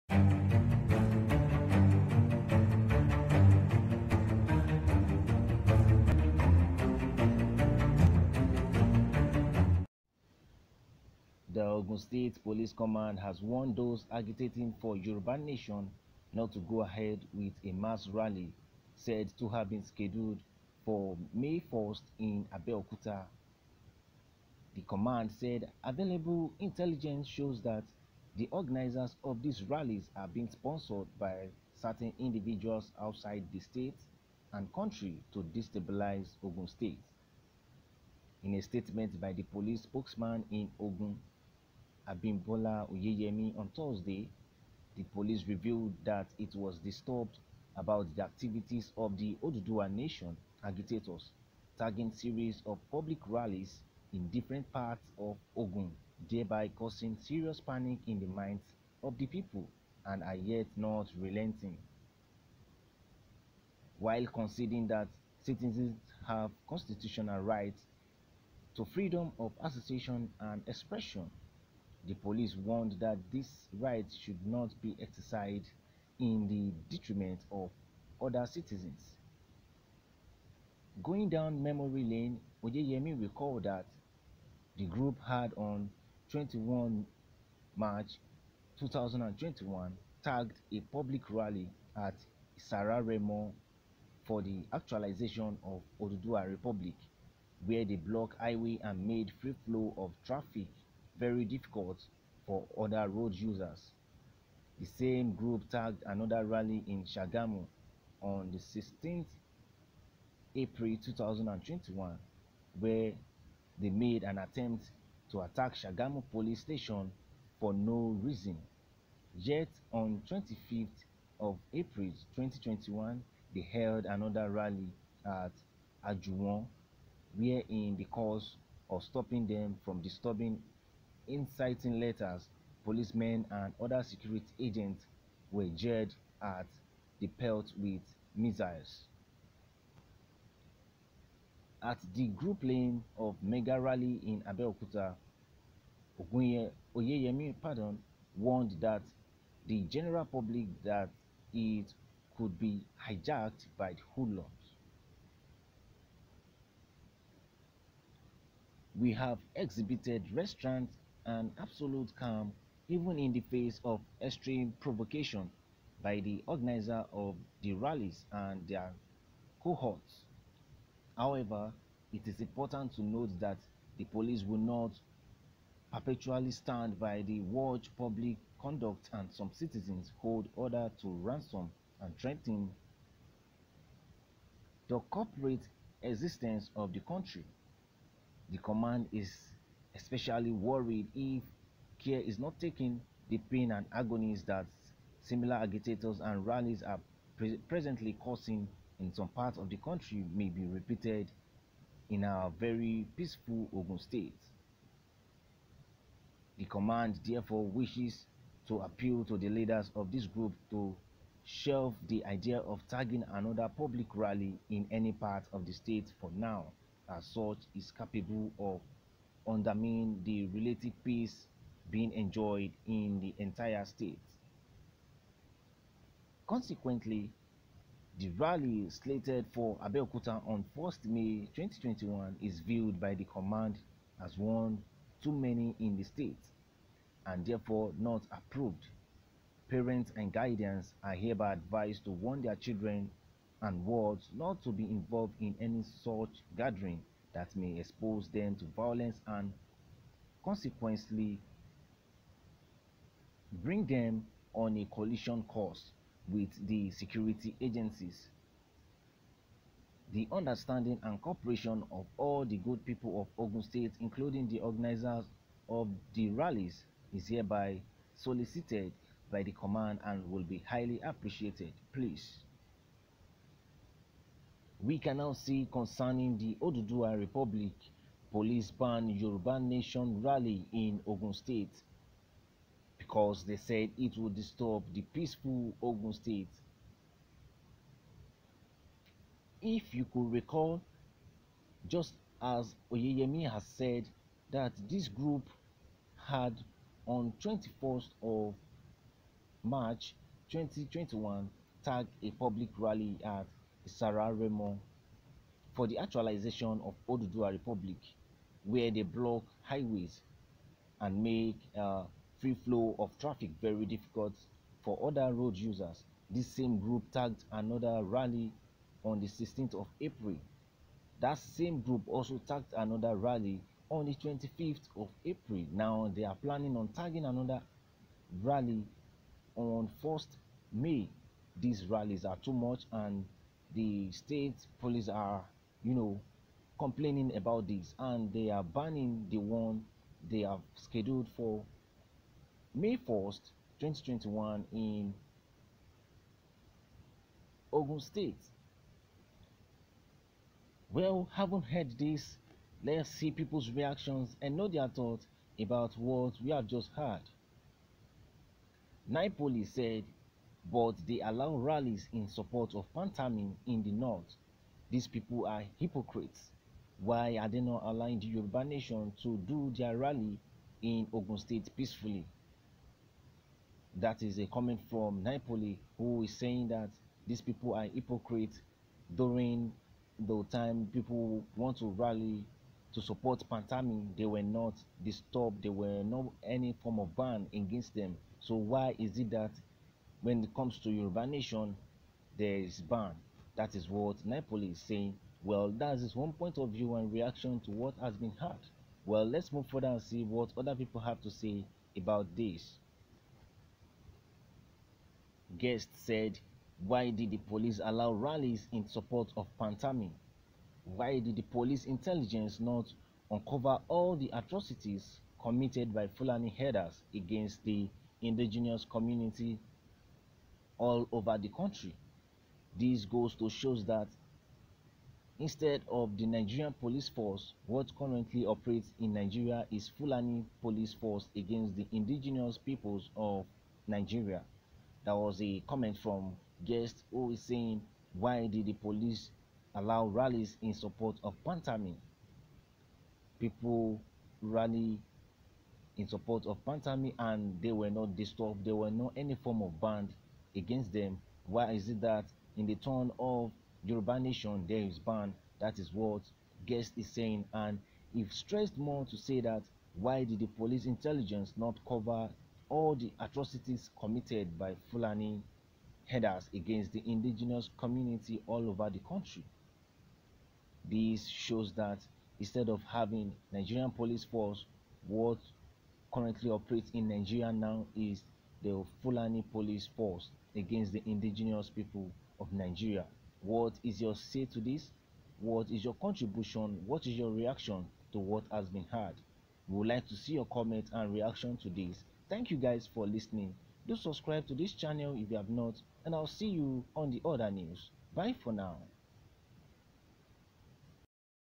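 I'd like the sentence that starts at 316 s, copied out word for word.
This same group tagged another rally on the 16th of April.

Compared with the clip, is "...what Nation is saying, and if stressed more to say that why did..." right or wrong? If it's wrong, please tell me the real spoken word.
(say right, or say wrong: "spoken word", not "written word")
wrong: "Guest", not "Nation".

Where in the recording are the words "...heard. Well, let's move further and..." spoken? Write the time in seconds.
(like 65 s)
398 s.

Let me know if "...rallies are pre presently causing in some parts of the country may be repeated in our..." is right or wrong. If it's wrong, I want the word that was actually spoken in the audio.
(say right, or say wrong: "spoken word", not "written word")
right.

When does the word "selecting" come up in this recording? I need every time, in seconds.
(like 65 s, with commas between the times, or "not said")
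not said.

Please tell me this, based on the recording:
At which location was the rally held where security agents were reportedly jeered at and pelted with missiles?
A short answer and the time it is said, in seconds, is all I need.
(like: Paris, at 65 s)
Ajuwon, at 126 s.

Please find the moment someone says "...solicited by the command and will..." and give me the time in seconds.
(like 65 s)
268 s.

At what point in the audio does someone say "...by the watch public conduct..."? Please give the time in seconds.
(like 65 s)
176 s.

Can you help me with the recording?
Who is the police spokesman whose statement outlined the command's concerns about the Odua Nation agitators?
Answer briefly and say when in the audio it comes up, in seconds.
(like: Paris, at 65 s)
Abimbola Oyeyemi, at 42 s.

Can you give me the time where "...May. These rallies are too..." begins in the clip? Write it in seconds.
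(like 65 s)
330 s.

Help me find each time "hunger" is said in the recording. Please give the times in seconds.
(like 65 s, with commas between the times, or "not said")
not said.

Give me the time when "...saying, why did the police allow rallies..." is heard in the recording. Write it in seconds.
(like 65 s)
437 s.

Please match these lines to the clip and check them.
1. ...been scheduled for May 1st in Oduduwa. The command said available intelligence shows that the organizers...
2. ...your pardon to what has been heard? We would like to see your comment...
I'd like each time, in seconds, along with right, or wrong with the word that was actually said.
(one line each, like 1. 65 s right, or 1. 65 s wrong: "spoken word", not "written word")
1. 19 s wrong: "Abeokuta", not "Oduduwa"
2. 487 s wrong: "reaction", not "pardon".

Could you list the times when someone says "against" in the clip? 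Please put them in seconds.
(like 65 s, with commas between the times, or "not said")
387 s, 417 s, 431 s, 450 s, 466 s, 480 s.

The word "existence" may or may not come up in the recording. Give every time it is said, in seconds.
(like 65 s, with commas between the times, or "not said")
186 s.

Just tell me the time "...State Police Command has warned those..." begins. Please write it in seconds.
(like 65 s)
11 s.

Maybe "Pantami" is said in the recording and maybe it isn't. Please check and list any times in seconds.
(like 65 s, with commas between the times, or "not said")
362 s, 383 s, 409 s, 441 s, 446 s.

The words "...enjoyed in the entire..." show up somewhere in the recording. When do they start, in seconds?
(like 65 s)
222 s.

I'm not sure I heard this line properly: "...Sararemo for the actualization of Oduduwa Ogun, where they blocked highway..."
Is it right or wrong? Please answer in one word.
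wrong.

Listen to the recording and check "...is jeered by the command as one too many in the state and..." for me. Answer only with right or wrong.
wrong.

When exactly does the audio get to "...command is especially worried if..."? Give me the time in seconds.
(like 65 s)
188 s.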